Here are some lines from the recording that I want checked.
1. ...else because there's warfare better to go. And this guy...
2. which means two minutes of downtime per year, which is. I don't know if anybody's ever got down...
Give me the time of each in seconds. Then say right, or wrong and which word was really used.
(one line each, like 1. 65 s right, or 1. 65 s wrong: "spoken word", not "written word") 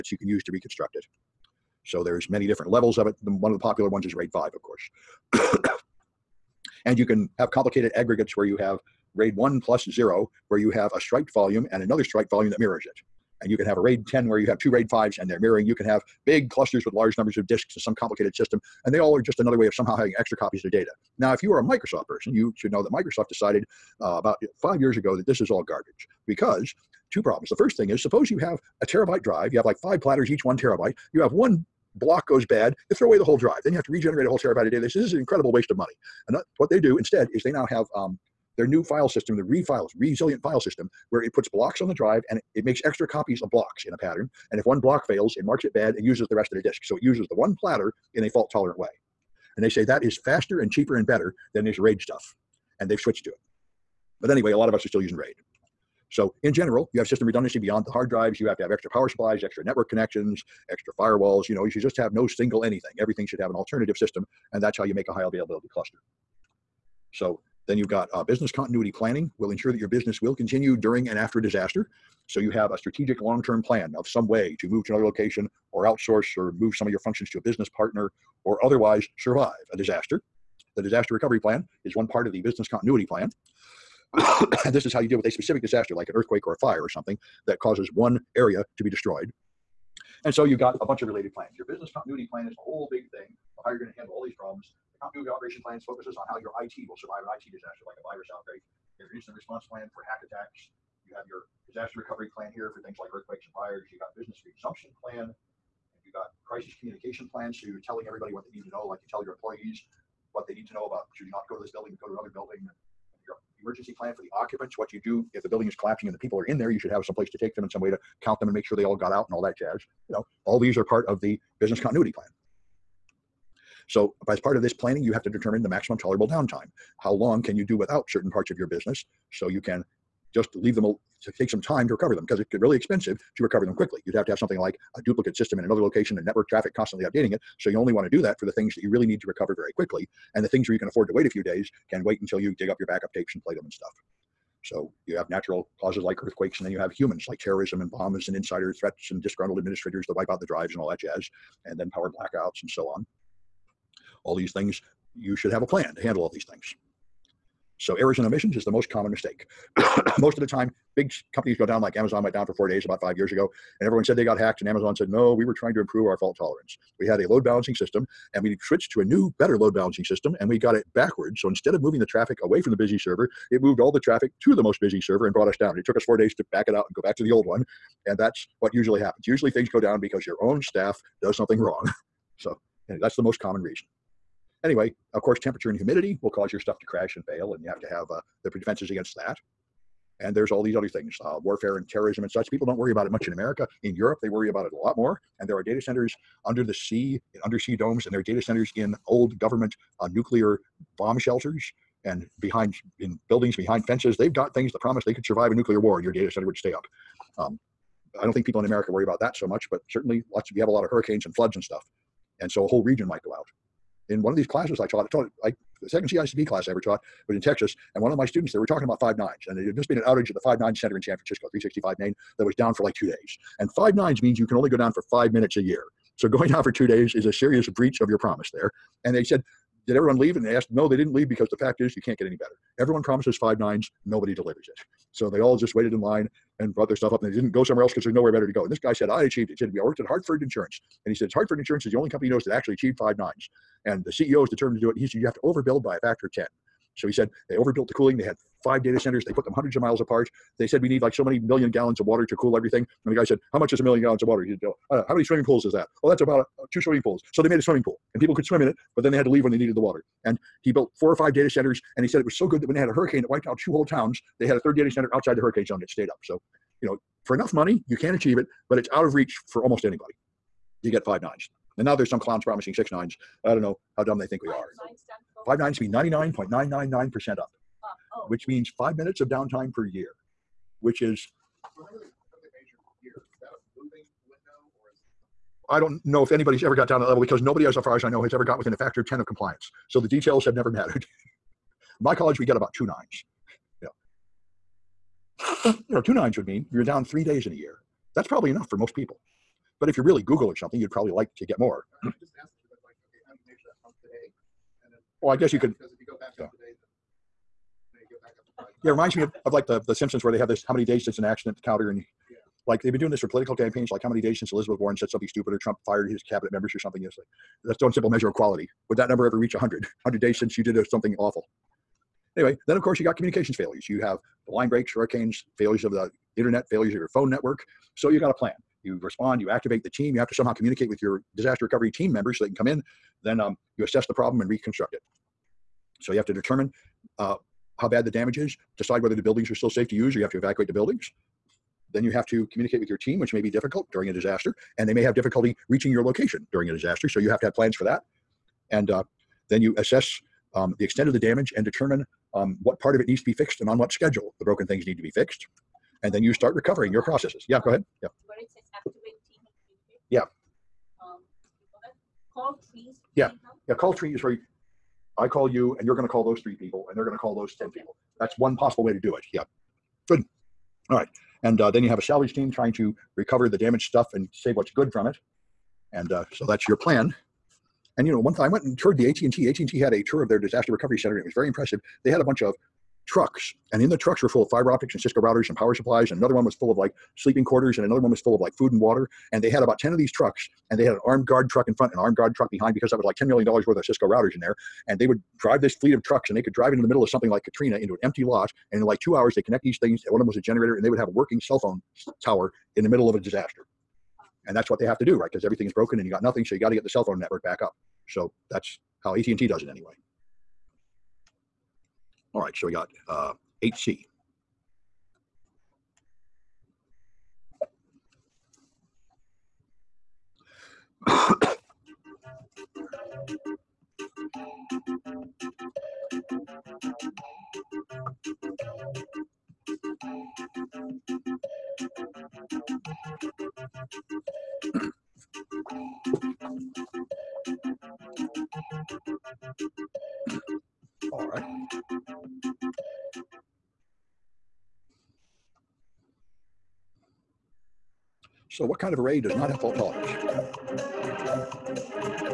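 1. 237 s wrong: "nowhere", not "warfare"
2. 278 s wrong: "five", not "two".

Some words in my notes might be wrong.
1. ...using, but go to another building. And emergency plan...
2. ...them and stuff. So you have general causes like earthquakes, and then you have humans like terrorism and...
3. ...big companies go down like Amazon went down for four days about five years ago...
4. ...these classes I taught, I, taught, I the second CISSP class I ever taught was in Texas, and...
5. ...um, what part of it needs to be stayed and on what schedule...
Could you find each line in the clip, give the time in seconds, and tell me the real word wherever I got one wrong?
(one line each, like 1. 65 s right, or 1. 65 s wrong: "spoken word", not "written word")
1. 111 s wrong: "building", not "using"
2. 143 s wrong: "natural", not "general"
3. 160 s right
4. 214 s right
5. 352 s wrong: "fixed", not "stayed".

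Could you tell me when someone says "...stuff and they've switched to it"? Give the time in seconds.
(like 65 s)
52 s.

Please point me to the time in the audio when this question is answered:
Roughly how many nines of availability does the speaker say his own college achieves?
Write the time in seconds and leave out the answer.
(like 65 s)
292 s.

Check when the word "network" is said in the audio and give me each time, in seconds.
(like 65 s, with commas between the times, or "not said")
59 s, 136 s, 327 s, 407 s.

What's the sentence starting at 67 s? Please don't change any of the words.
So then you've got uh, business continuity planning will ensure that your business will continue during and after a disaster.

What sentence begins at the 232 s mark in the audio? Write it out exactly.
Everyone promises five nines, nobody delivers it.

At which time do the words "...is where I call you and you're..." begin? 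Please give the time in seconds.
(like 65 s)
364 s.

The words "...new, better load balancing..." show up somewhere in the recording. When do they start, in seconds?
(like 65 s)
169 s.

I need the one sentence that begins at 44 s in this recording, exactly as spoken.
And if one block fails, it marks it bad and uses the rest of the disk.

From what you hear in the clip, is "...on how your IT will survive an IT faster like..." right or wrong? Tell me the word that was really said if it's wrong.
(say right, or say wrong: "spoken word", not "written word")
wrong: "disaster", not "faster".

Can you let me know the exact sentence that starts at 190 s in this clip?
And there's all these other things, uh, warfare and terrorism and such.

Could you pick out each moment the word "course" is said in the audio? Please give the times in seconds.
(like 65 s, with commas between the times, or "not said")
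4 s, 185 s, 322 s.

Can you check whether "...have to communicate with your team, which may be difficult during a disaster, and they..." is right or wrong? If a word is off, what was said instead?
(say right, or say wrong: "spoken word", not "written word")
right.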